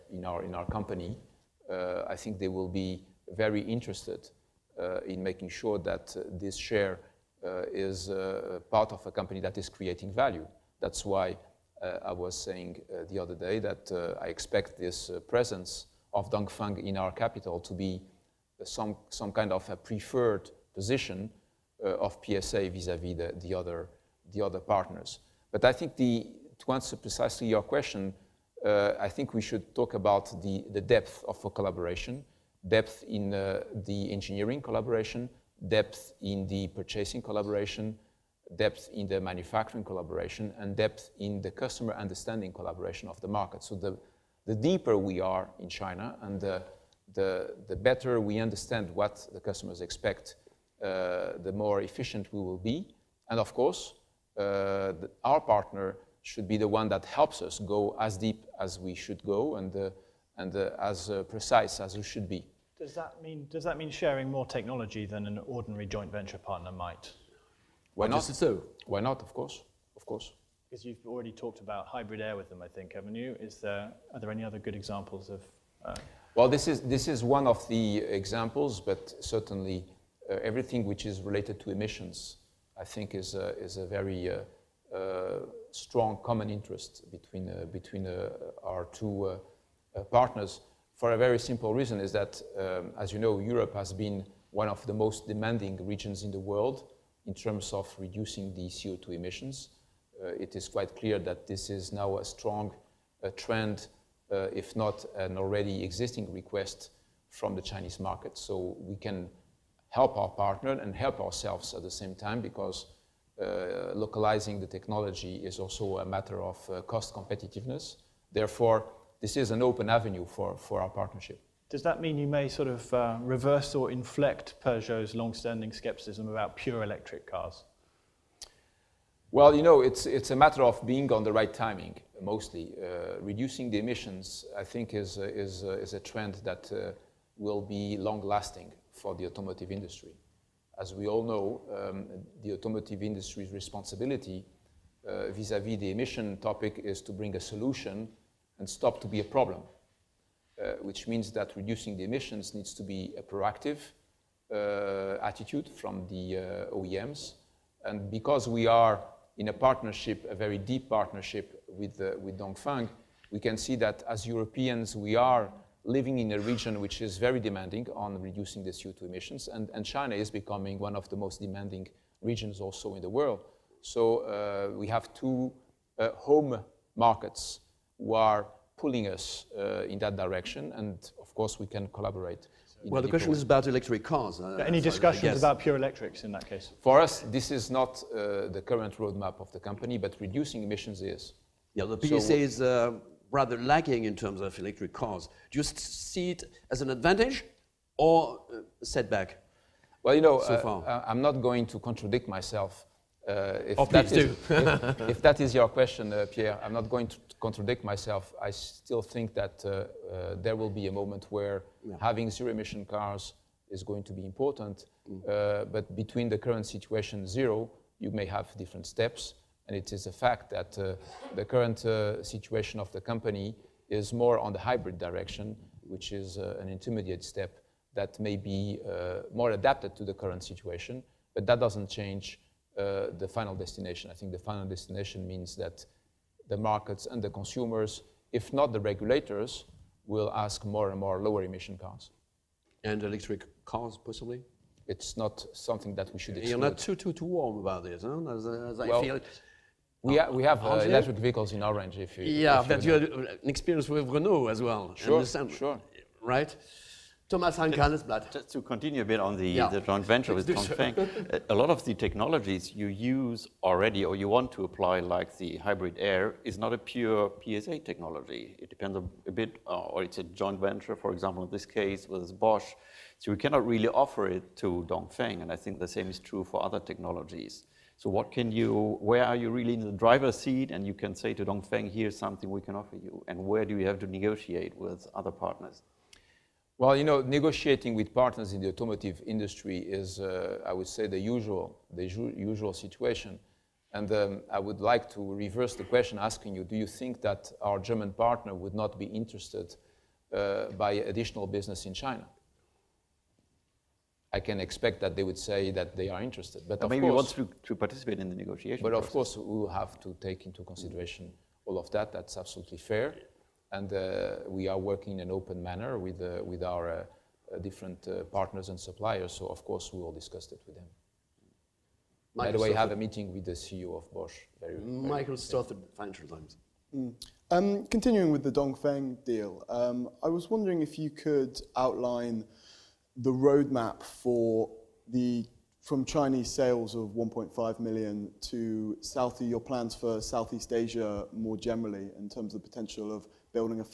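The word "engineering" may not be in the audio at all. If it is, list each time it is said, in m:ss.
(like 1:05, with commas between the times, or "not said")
0:34.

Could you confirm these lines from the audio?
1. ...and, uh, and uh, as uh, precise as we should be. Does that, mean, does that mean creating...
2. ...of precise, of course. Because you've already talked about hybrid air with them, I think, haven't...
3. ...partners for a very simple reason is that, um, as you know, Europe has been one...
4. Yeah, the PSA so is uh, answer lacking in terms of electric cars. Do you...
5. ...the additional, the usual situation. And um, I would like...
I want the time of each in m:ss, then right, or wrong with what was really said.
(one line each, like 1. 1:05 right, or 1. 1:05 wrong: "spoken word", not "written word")
1. 0:59 wrong: "sharing", not "creating"
2. 1:09 wrong: "course", not "precise"
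3. 1:30 right
4. 3:11 wrong: "rather", not "answer"
5. 4:51 wrong: "usual", not "additional".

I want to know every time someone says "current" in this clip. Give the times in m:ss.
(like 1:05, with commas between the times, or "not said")
3:08, 3:36, 3:41, 3:50.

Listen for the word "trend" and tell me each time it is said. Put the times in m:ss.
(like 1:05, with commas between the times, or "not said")
1:43, 2:16.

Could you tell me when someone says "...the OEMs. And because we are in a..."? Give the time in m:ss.
2:36.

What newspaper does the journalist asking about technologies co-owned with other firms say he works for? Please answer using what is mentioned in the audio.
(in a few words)
Handelsblatt.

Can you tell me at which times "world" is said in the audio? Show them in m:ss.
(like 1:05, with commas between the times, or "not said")
1:36, 2:53.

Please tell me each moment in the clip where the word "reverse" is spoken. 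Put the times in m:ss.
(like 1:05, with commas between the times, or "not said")
2:03, 4:55.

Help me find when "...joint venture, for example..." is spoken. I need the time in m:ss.
4:30.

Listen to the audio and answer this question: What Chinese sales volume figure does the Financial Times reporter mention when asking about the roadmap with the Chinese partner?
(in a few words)
1.5 million.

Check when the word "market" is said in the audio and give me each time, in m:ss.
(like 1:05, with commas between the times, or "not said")
0:43, 1:47, 2:56, 3:56.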